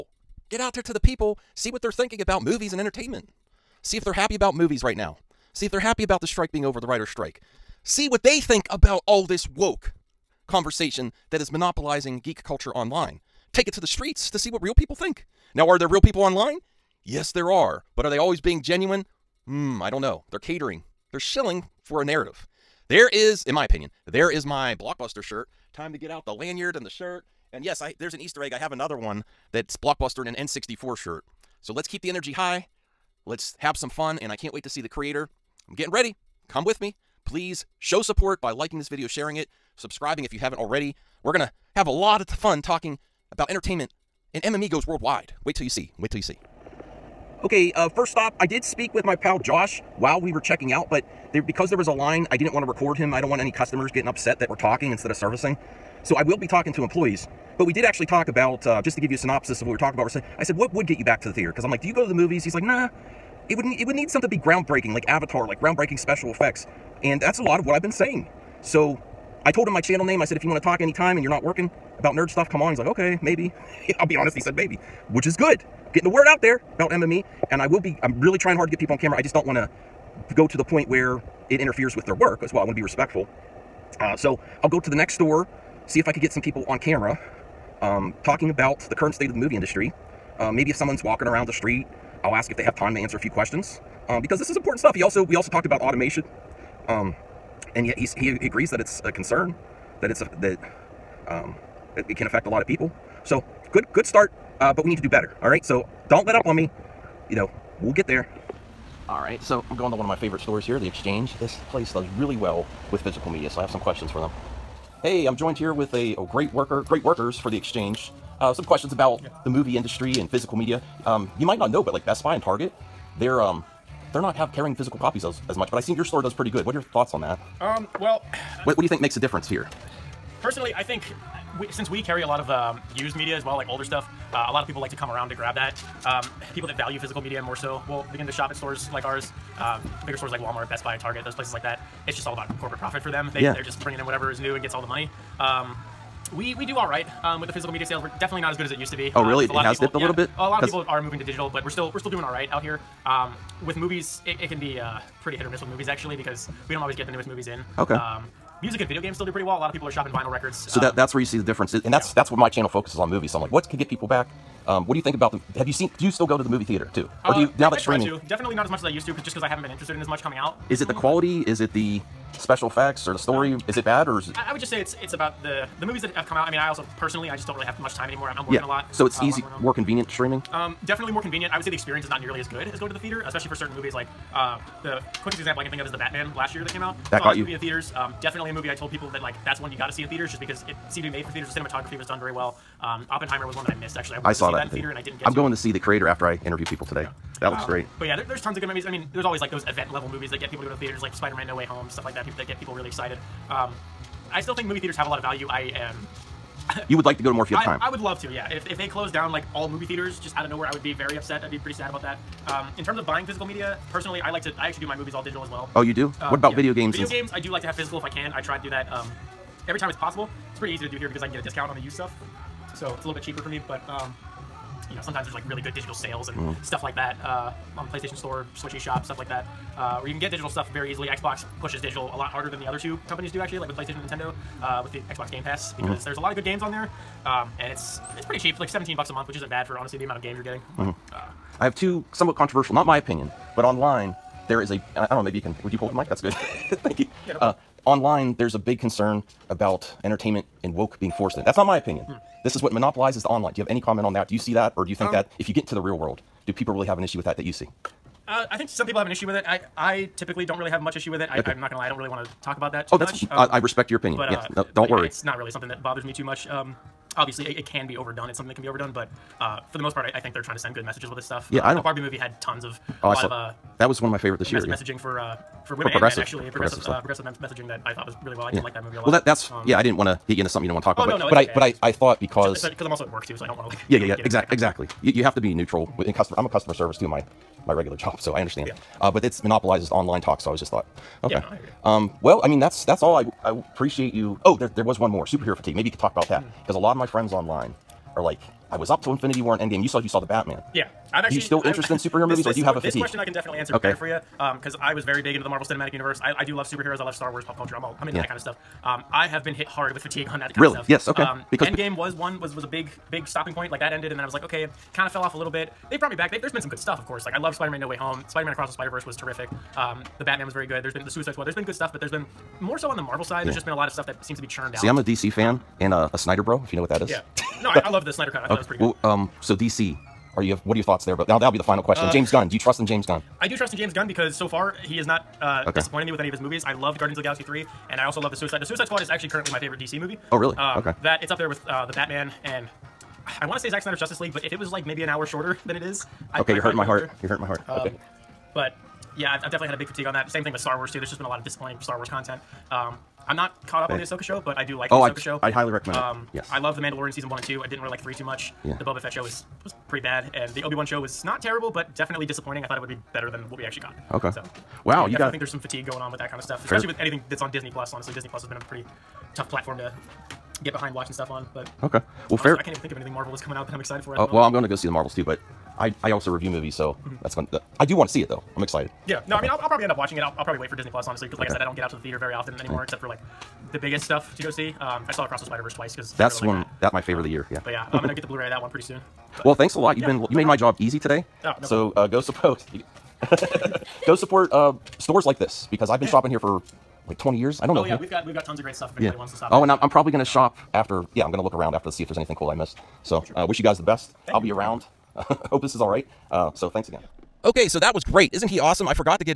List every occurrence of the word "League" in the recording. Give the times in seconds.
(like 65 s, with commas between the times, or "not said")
344 s.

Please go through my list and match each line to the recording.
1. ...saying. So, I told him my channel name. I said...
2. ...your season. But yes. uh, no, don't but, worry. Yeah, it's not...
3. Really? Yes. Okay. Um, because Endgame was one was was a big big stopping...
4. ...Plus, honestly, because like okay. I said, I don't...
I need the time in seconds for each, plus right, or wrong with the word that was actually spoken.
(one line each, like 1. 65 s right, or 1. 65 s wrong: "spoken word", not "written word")
1. 67 s right
2. 263 s wrong: "opinion", not "season"
3. 310 s right
4. 380 s right.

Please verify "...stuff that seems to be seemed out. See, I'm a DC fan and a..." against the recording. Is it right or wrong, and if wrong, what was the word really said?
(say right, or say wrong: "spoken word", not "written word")
wrong: "churned", not "seemed".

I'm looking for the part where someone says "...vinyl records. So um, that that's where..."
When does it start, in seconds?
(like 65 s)
160 s.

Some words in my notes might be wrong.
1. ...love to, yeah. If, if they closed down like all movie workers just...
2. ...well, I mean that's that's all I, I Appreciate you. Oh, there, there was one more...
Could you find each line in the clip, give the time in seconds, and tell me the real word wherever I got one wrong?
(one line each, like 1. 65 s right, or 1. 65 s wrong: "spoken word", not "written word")
1. 207 s wrong: "theaters", not "workers"
2. 292 s right.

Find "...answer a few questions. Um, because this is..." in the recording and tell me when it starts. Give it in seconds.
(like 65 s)
92 s.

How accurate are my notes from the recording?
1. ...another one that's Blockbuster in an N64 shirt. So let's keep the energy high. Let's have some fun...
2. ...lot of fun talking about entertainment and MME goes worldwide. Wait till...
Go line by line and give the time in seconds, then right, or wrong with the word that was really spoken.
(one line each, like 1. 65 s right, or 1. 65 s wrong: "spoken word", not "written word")
1. 28 s right
2. 41 s right.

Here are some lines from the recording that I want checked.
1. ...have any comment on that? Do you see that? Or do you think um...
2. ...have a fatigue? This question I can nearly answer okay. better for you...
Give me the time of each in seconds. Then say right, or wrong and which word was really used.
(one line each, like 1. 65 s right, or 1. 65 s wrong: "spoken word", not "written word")
1. 253 s right
2. 302 s wrong: "definitely", not "nearly".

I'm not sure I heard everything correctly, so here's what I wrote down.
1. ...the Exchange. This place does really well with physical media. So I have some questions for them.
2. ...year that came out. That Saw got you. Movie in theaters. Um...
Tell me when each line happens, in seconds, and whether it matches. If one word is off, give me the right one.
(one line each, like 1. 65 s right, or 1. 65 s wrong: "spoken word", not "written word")
1. 110 s right
2. 186 s right.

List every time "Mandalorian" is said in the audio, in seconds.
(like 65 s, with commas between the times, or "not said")
356 s.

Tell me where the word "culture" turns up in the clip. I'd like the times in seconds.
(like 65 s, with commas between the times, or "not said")
12 s, 307 s.